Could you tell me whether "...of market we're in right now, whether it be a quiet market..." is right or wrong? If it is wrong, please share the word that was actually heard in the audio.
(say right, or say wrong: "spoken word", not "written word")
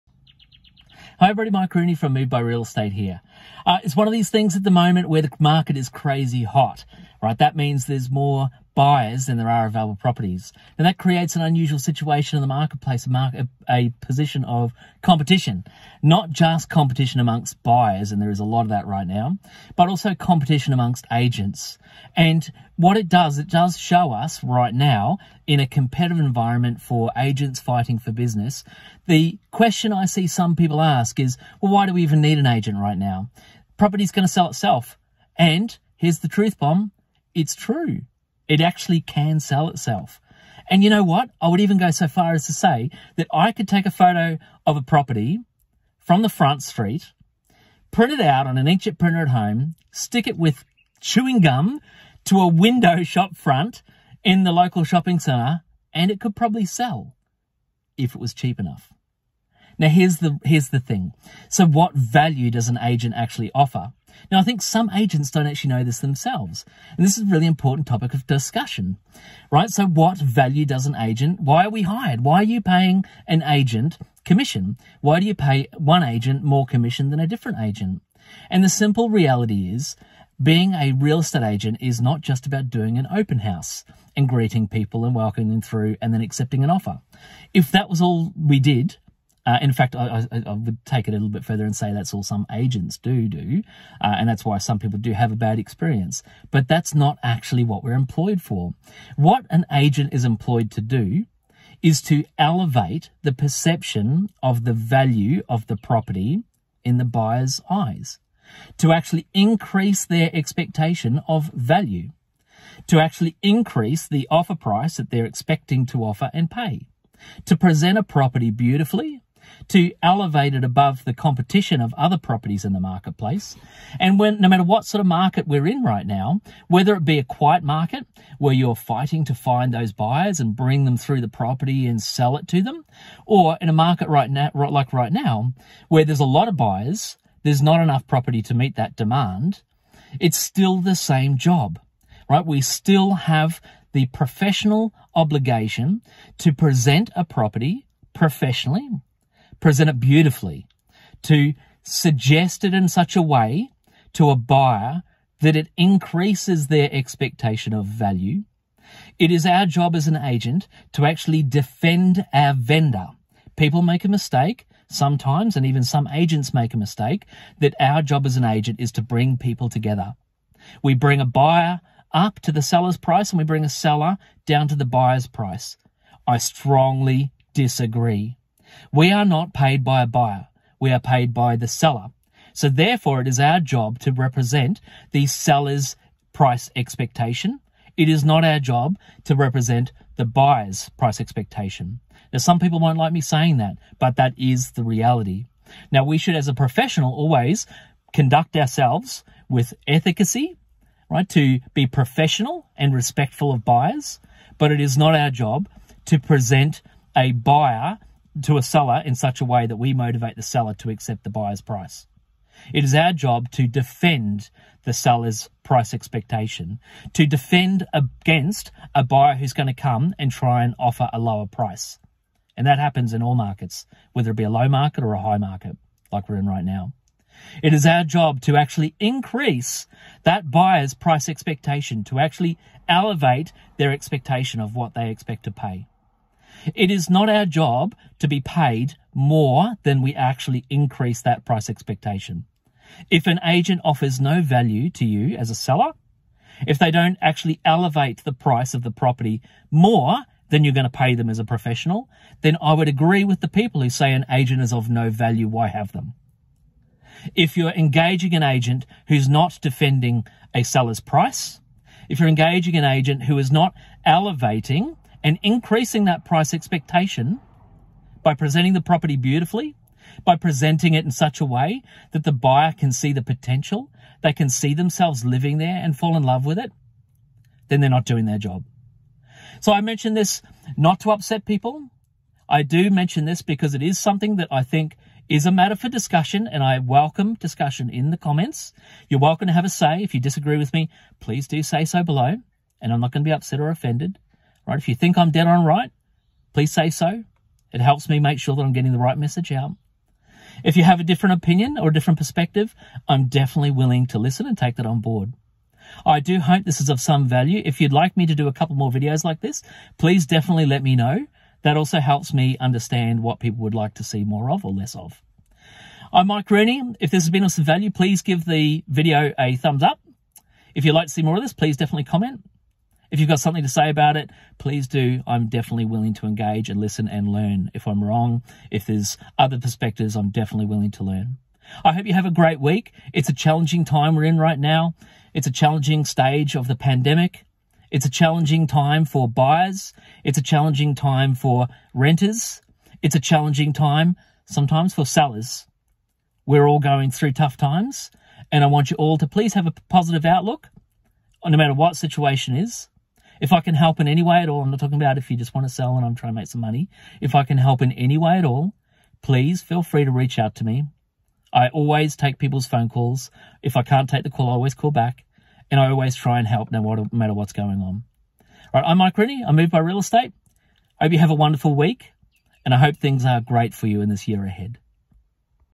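right.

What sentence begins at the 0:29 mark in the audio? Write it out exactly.
The question I see some people ask is, well, why do we even need an agent right now?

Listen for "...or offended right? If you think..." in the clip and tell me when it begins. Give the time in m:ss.
4:53.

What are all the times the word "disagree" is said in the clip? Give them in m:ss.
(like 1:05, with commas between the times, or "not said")
2:57, 4:50.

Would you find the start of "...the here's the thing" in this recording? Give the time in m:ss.
1:00.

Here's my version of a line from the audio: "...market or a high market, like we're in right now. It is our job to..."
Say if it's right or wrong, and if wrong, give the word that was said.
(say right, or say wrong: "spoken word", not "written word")
right.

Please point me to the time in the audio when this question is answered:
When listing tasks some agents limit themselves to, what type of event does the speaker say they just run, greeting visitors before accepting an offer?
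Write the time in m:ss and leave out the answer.
1:23.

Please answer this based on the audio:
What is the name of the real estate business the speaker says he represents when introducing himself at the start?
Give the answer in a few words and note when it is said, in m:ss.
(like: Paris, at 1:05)
MovedBy Real Estate, at 0:02.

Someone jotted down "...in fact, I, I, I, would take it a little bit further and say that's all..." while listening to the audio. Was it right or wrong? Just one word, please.
right.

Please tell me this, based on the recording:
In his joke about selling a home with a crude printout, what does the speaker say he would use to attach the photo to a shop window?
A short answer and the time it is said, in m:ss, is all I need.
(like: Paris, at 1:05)
Chewing gum, at 0:50.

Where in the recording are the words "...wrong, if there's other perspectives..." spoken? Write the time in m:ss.
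5:28.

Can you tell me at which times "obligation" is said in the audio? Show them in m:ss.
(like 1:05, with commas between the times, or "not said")
2:25.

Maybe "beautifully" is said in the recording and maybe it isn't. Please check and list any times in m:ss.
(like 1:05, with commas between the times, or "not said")
1:58, 2:29, 4:29.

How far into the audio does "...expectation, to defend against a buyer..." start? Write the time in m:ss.
3:35.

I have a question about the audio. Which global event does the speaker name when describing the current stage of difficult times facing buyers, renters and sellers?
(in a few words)
The pandemic.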